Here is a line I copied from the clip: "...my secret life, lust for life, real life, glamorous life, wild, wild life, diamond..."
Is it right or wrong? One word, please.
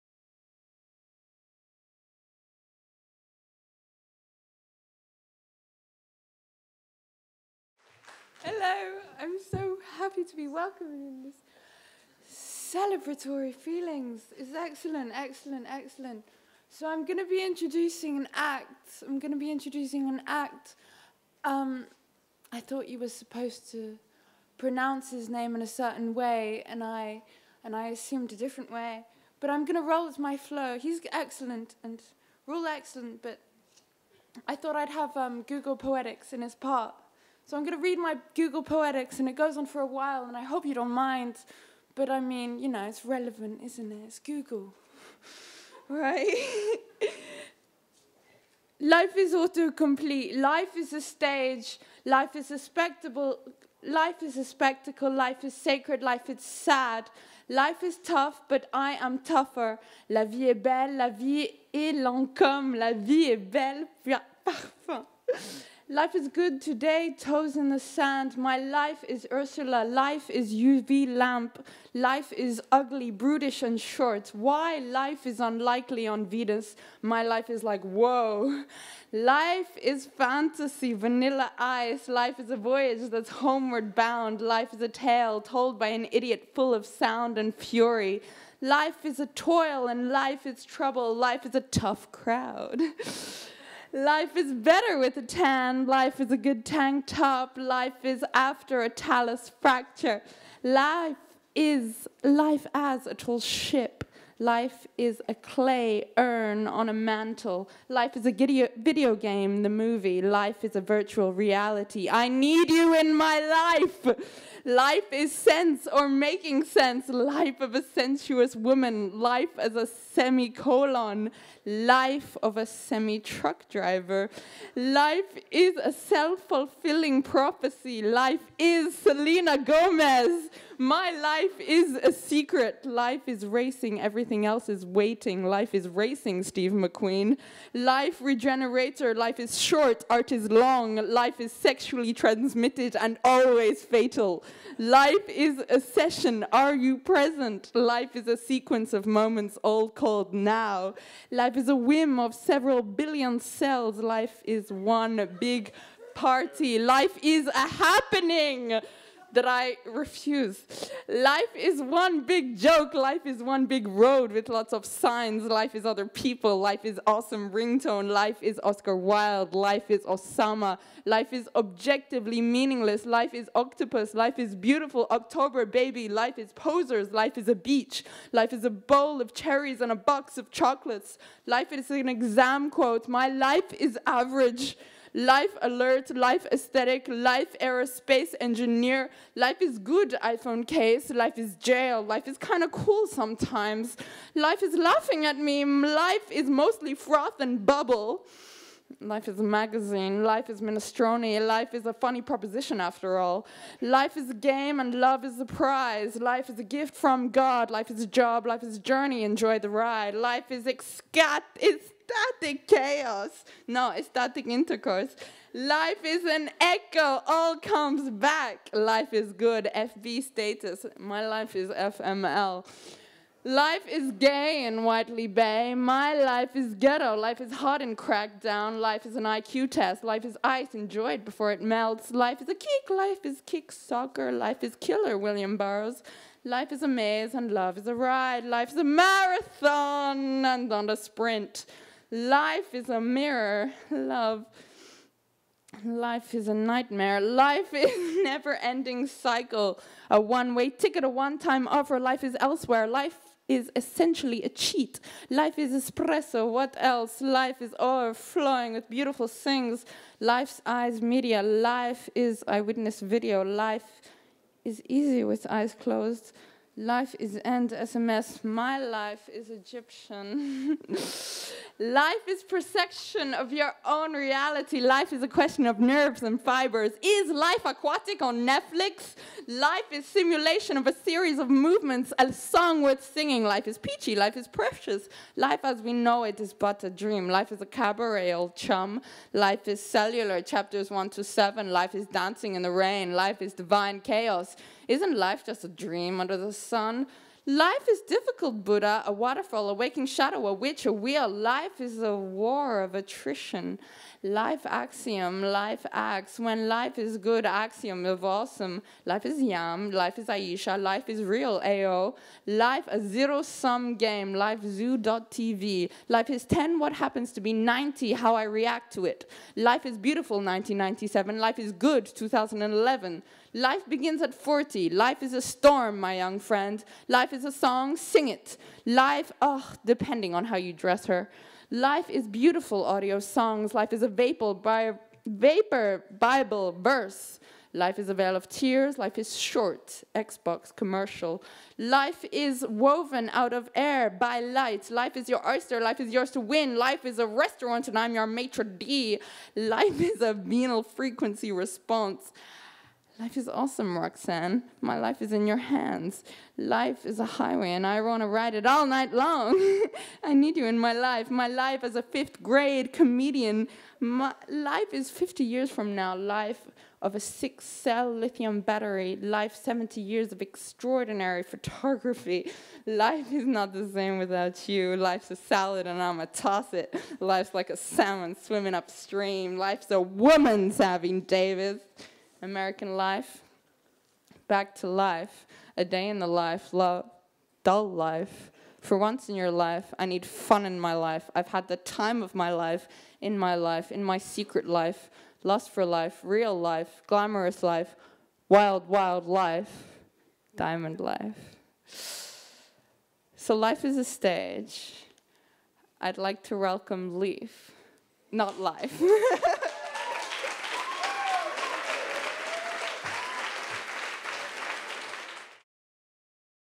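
right.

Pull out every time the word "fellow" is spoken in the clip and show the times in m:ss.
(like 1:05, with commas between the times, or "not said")
not said.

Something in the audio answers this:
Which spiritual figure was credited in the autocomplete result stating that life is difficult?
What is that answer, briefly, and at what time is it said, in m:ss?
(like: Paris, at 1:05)
Buddha, at 4:58.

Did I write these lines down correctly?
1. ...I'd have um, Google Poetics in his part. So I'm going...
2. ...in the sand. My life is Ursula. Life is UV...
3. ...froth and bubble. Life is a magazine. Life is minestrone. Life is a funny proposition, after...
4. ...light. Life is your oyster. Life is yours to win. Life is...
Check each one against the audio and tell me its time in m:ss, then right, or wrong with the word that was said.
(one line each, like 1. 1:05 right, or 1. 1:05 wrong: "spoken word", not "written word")
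1. 0:34 right
2. 1:07 right
3. 3:16 right
4. 5:44 right.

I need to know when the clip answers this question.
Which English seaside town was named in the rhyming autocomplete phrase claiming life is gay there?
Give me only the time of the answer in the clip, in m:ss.
3:44.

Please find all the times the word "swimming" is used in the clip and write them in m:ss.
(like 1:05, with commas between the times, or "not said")
6:18.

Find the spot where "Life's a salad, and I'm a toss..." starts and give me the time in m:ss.
6:14.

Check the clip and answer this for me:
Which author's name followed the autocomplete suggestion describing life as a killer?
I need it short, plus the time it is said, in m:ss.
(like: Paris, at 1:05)
William Burroughs, at 3:55.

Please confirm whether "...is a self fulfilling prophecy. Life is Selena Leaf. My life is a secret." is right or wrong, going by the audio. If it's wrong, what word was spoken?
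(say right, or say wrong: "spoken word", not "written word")
wrong: "Gomez", not "Leaf".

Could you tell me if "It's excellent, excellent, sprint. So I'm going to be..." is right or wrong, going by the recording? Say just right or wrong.
wrong.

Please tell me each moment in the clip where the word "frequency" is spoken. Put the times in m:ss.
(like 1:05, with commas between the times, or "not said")
5:50.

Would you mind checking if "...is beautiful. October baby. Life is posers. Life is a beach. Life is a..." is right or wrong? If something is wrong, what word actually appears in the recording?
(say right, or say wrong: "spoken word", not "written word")
right.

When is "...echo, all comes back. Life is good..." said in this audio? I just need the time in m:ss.
3:36.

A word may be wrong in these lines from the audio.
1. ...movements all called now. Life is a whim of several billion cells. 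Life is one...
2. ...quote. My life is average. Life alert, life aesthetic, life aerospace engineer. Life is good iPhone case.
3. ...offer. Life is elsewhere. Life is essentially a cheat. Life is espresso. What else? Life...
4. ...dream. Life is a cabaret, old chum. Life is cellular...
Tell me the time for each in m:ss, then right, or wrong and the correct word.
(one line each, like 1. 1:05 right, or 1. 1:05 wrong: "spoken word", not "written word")
1. 2:29 wrong: "moments", not "movements"
2. 3:02 right
3. 4:11 right
4. 4:46 right.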